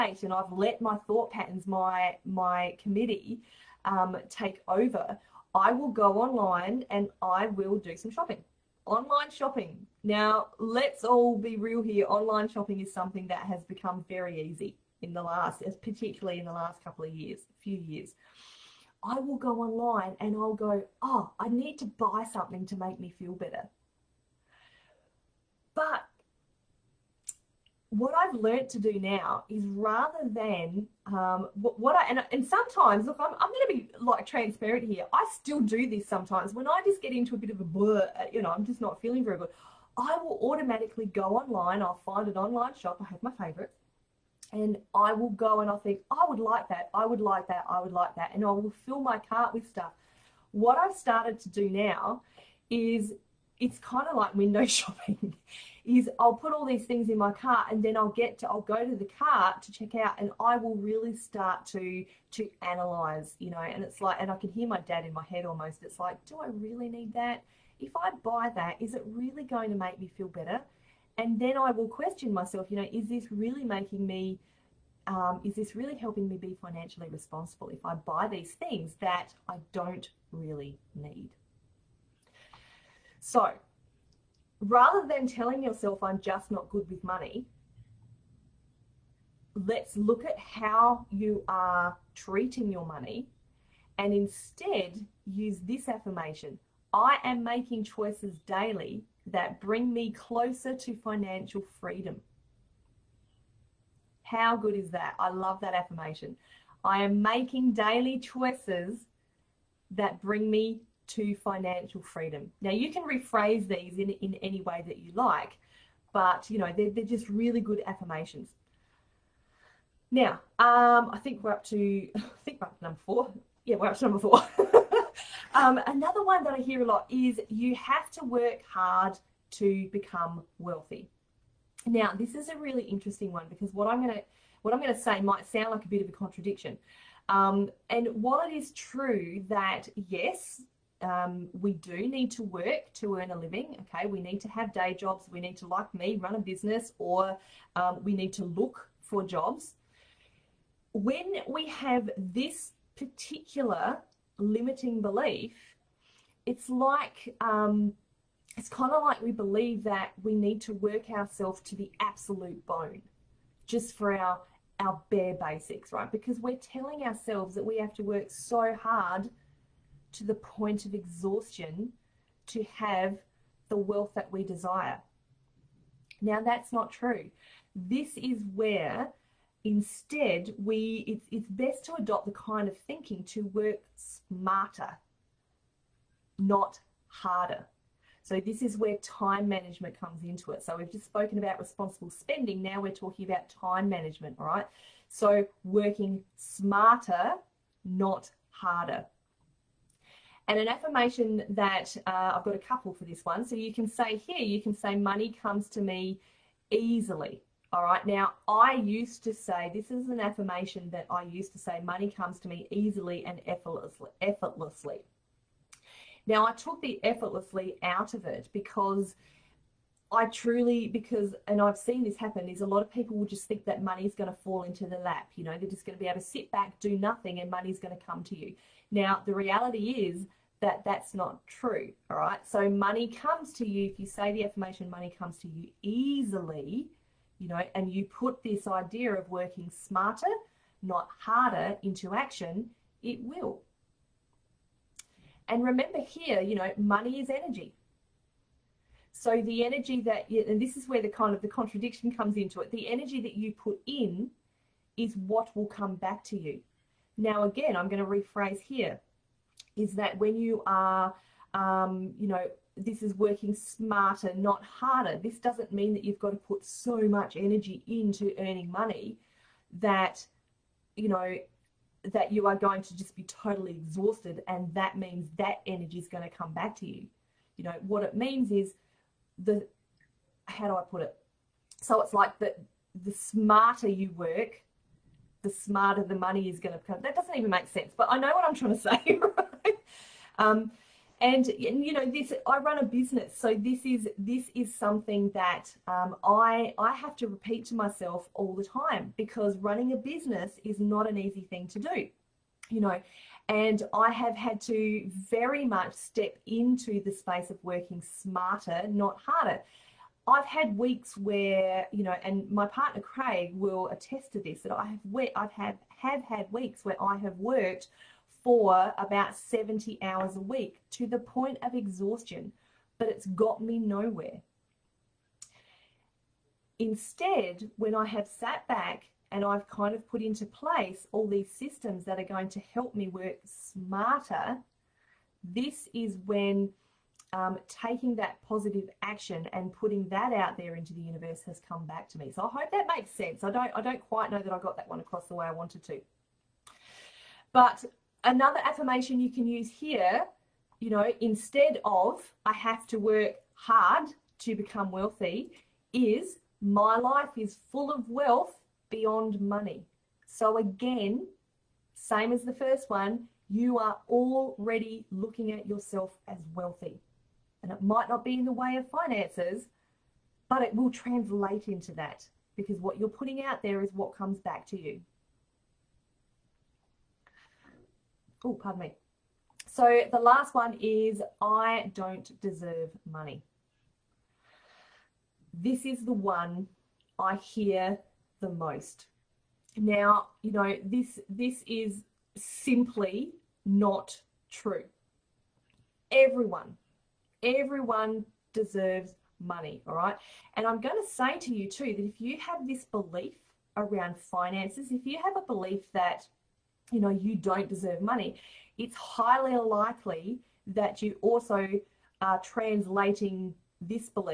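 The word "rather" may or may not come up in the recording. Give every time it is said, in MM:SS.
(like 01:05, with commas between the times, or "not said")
00:29, 01:24.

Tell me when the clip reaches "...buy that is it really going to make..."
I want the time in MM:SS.
01:08.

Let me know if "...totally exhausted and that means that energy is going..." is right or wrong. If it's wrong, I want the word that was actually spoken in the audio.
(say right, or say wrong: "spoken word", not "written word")
right.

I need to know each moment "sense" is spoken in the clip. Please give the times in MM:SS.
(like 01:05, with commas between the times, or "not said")
04:47, 05:43.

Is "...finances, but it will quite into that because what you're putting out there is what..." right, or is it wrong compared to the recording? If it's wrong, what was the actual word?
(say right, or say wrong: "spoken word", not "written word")
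wrong: "translate", not "quite".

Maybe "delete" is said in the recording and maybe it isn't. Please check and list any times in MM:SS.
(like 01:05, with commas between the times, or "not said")
not said.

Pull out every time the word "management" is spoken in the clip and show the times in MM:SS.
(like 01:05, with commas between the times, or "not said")
03:09, 03:13.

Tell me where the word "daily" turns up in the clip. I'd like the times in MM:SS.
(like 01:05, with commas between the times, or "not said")
01:38, 01:47.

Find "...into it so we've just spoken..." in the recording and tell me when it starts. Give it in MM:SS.
03:10.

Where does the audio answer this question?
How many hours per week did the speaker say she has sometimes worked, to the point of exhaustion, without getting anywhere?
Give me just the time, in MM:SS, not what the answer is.
05:19.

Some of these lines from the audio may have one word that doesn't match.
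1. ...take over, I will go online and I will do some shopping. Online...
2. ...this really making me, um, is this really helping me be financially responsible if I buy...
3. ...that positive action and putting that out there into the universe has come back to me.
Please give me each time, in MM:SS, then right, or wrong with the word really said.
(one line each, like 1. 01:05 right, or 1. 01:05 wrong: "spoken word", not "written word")
1. 00:04 right
2. 01:13 right
3. 05:38 right.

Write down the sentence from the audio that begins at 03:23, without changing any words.
So you can say here, you can say, money comes to me easily.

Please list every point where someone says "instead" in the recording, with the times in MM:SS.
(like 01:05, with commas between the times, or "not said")
01:34, 02:59, 05:26, 05:51.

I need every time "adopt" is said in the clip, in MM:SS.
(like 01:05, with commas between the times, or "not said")
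03:01.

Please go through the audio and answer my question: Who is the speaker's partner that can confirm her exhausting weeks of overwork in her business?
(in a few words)
Craig.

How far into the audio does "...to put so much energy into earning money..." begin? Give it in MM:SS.
04:26.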